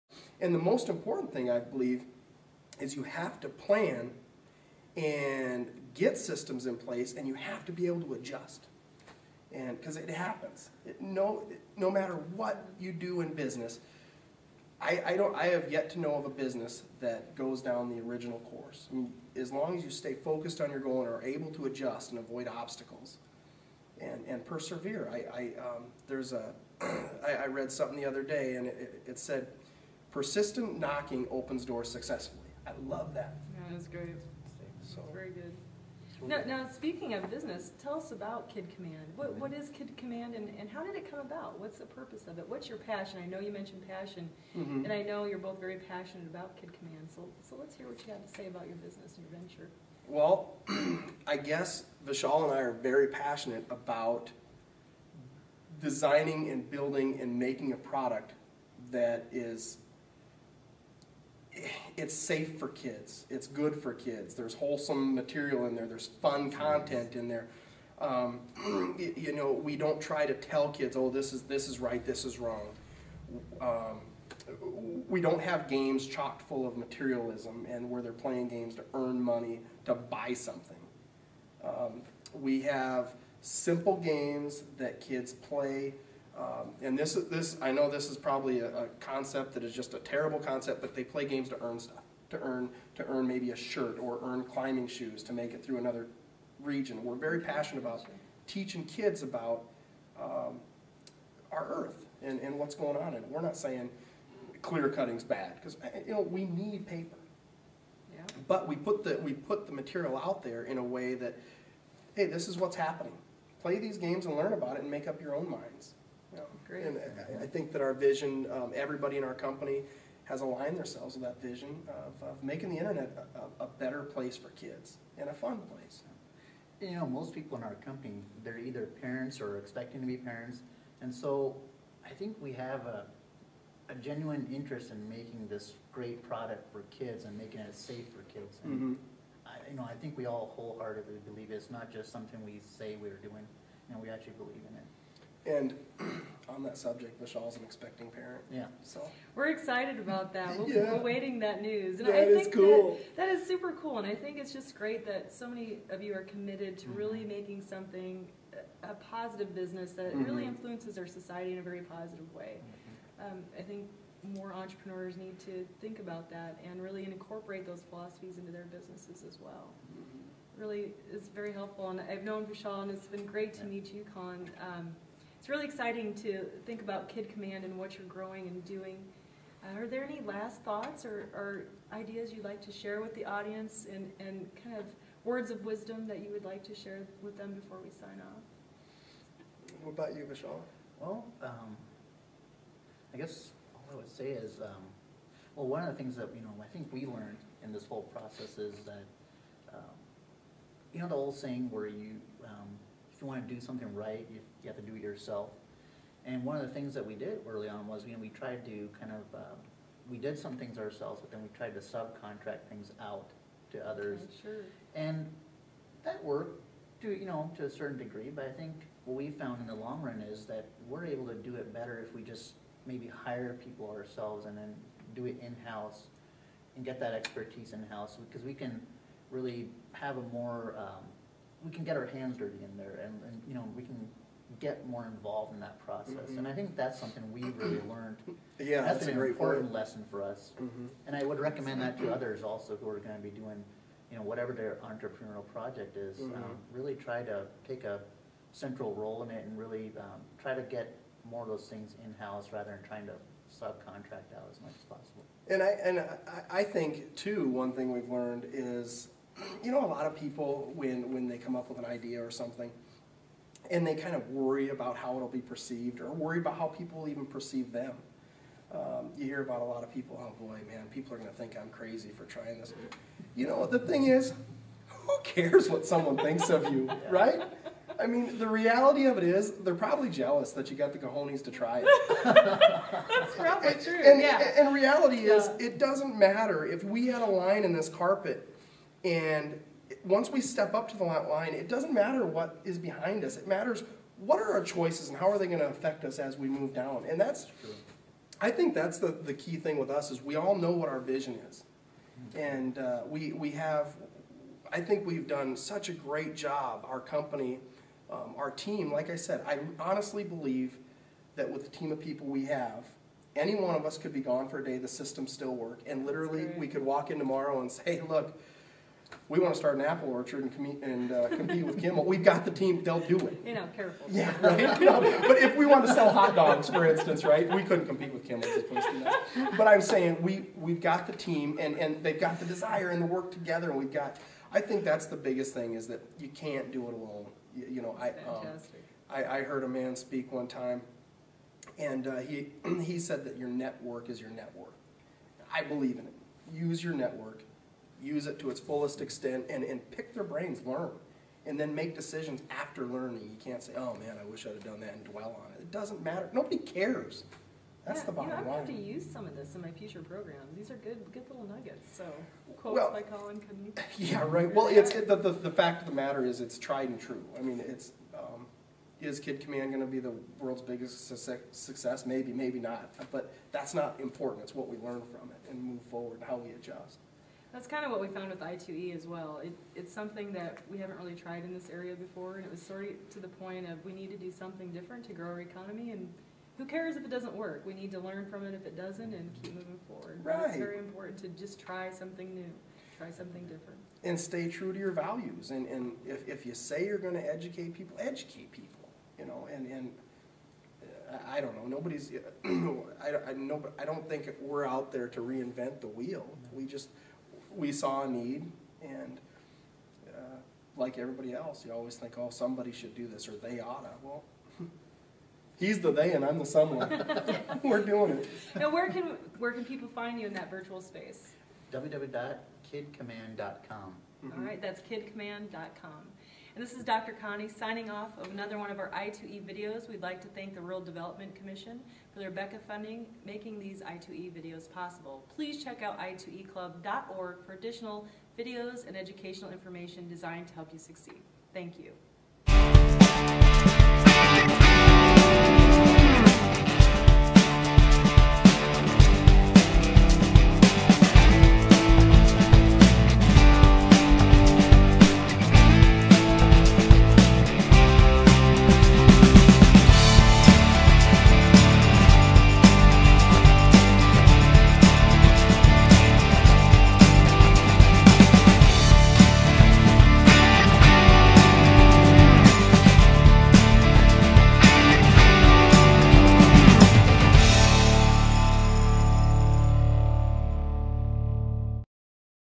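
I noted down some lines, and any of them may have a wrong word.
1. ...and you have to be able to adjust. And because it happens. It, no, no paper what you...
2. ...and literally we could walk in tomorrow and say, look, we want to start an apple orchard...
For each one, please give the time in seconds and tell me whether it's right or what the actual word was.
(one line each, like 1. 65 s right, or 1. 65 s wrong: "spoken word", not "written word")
1. 7 s wrong: "matter", not "paper"
2. 315 s right.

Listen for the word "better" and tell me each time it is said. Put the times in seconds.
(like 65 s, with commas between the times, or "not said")
123 s, 221 s.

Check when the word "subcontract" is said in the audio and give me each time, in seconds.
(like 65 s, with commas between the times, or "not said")
211 s, 253 s.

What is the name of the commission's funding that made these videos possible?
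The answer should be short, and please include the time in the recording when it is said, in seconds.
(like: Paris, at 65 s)
BECCA, at 432 s.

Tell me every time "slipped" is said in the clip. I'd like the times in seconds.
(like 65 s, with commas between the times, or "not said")
not said.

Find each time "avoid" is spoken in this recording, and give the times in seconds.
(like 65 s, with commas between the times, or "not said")
22 s.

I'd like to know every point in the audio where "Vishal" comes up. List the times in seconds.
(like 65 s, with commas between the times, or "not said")
52 s, 172 s.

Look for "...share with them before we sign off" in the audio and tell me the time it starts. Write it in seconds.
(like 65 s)
186 s.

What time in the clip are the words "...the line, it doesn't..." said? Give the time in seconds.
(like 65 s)
290 s.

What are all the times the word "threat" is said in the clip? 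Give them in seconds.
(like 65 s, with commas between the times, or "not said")
not said.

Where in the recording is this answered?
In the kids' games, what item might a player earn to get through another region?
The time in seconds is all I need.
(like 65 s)
94 s.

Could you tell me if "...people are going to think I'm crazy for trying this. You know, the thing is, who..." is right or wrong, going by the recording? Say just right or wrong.
right.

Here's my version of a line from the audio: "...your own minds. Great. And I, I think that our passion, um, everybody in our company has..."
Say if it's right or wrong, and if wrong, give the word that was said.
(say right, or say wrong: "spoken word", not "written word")
wrong: "vision", not "passion".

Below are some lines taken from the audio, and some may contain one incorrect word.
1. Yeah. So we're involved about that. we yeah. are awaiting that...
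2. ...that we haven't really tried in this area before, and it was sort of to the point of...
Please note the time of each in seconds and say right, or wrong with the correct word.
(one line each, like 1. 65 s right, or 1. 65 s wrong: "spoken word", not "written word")
1. 148 s wrong: "excited", not "involved"
2. 380 s right.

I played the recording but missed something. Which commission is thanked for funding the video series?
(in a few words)
Rural Development Commission.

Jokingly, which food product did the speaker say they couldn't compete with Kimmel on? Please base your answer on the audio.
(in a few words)
hot dogs.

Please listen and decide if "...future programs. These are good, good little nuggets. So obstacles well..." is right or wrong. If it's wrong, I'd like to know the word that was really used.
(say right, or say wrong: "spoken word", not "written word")
wrong: "quotes", not "obstacles".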